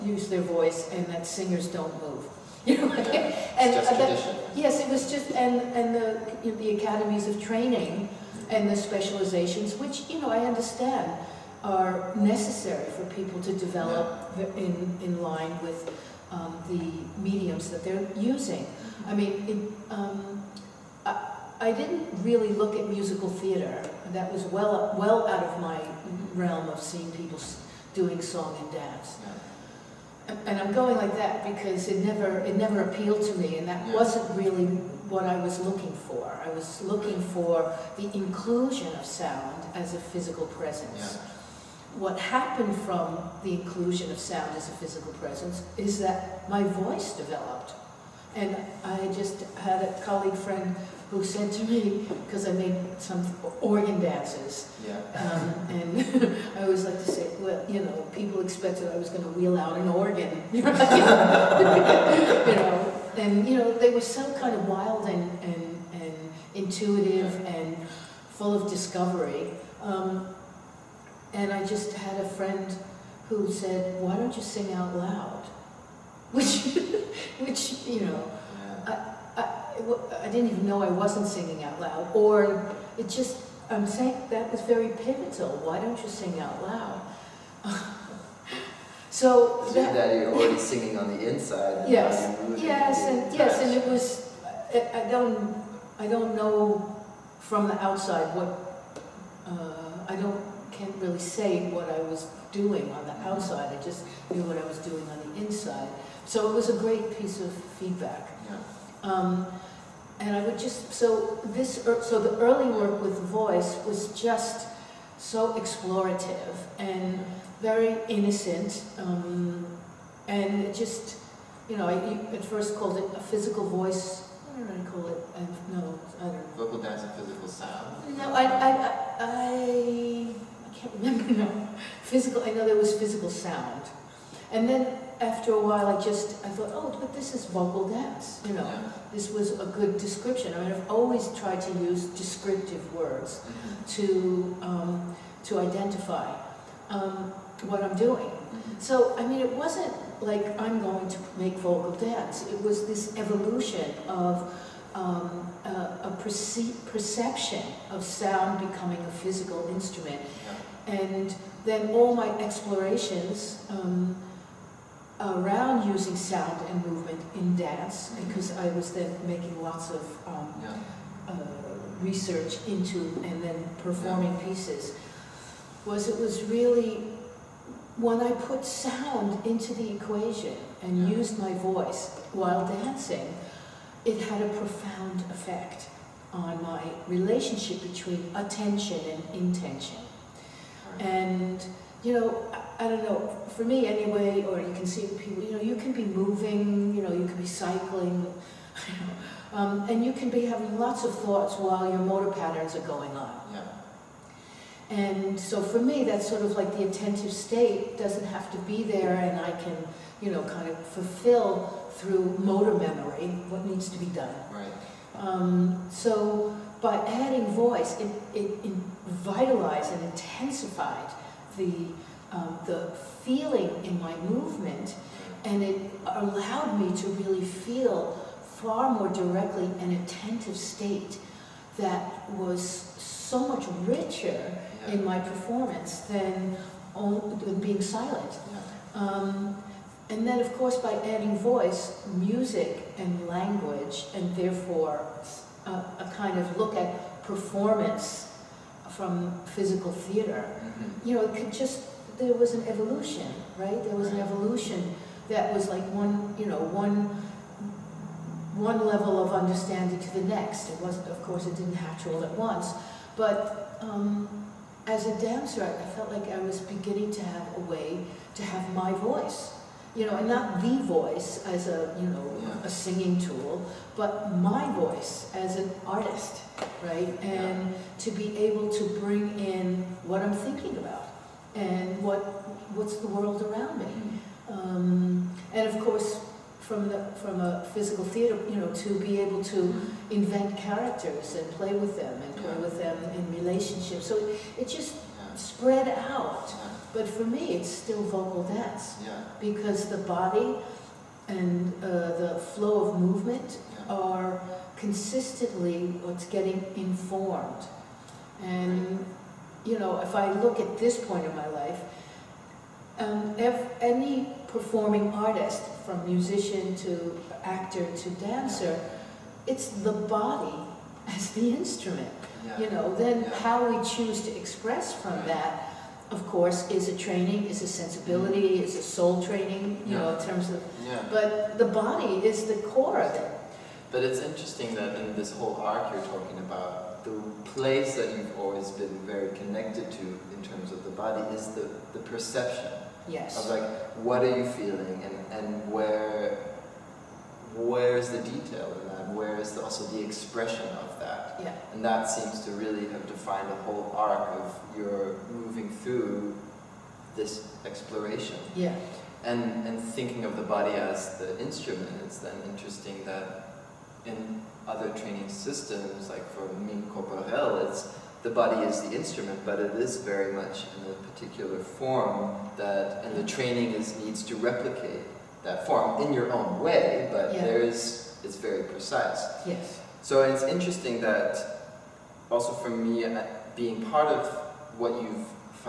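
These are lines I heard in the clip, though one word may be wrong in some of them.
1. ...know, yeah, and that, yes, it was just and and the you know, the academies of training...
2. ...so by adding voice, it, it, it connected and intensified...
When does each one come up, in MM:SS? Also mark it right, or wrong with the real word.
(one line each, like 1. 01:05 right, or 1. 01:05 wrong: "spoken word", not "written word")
1. 00:02 right
2. 03:35 wrong: "vitalized", not "connected".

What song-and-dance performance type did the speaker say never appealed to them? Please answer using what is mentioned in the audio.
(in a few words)
musical theater.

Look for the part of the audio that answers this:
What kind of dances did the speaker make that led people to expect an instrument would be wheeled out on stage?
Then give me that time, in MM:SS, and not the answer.
00:53.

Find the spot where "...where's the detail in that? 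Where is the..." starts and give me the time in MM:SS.
05:47.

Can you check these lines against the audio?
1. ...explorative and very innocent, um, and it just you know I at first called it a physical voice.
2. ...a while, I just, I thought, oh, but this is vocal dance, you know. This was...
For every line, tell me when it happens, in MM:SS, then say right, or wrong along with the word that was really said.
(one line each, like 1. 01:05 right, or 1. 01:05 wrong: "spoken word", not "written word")
1. 01:55 right
2. 02:15 right.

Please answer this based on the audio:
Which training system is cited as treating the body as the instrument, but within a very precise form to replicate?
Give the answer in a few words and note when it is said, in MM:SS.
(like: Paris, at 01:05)
Mime Corporel, at 06:06.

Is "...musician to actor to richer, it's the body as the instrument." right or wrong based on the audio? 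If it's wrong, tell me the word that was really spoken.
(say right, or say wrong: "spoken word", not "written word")
wrong: "dancer", not "richer".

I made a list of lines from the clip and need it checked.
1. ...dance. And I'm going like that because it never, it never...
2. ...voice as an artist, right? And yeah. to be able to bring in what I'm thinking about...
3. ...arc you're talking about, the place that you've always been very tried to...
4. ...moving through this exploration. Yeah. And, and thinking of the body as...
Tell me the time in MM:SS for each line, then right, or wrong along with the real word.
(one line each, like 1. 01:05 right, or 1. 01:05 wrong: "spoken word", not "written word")
1. 00:28 right
2. 04:34 right
3. 05:35 wrong: "connected", not "tried"
4. 05:55 right.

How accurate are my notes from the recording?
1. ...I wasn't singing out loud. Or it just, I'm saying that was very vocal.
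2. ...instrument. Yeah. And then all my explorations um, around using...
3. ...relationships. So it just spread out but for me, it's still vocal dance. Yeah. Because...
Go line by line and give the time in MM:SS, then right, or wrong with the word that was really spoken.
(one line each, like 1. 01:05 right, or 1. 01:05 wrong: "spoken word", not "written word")
1. 01:20 wrong: "pivotal", not "vocal"
2. 02:39 right
3. 04:53 right.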